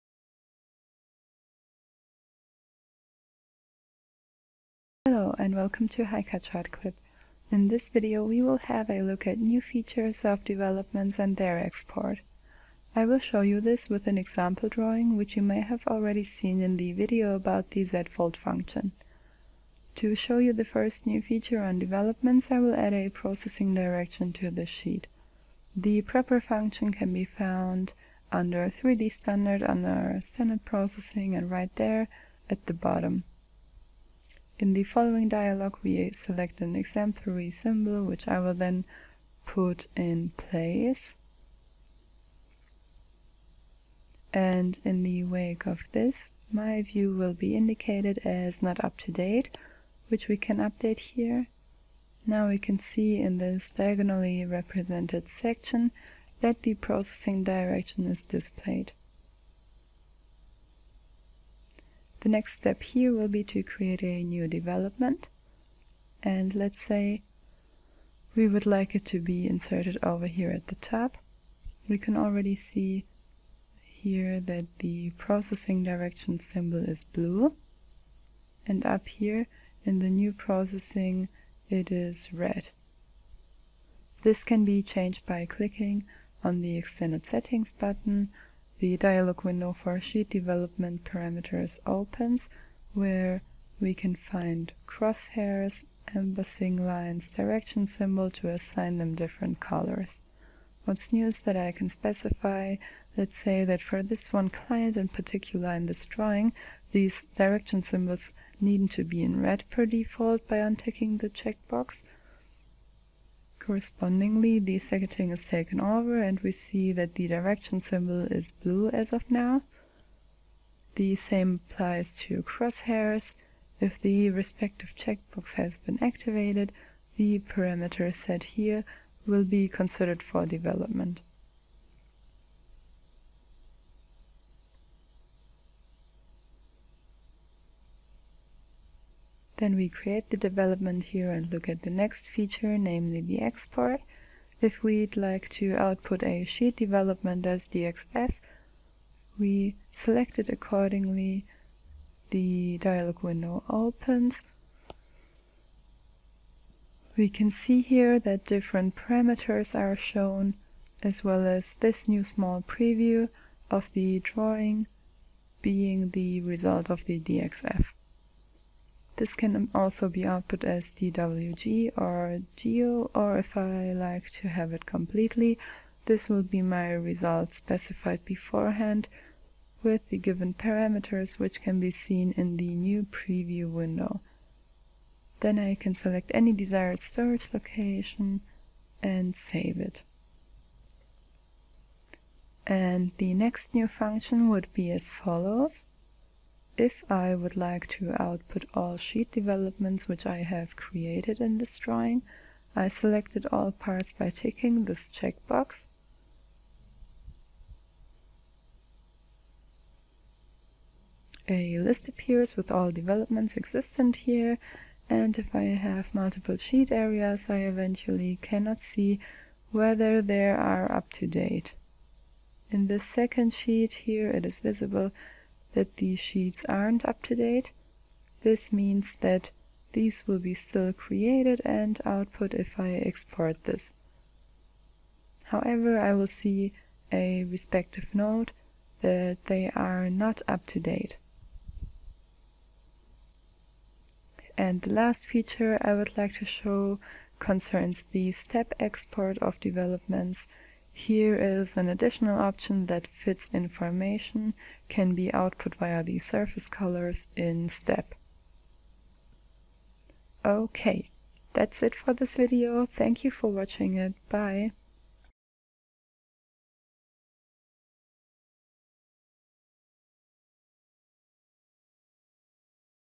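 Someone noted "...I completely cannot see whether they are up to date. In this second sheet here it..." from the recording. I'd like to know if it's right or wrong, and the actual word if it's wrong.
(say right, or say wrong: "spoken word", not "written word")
wrong: "eventually", not "completely".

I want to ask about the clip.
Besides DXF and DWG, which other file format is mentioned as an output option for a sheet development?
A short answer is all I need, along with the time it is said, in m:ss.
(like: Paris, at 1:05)
geo, at 2:52.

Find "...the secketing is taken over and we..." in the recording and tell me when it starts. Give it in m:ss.
1:54.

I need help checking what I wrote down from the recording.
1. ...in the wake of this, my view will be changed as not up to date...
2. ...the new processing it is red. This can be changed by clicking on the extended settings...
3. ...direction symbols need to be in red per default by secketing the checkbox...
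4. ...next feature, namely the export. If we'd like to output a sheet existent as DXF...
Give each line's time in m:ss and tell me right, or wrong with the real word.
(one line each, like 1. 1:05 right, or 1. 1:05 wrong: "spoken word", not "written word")
1. 0:44 wrong: "indicated", not "changed"
2. 1:19 right
3. 1:47 wrong: "unticking", not "secketing"
4. 2:21 wrong: "development", not "existent".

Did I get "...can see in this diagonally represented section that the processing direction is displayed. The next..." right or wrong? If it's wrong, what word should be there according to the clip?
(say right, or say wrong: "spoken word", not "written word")
right.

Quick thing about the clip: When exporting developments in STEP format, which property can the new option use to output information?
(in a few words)
surface colors.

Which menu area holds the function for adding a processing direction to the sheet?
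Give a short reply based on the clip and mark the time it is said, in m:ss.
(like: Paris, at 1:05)
3D standard, at 0:28.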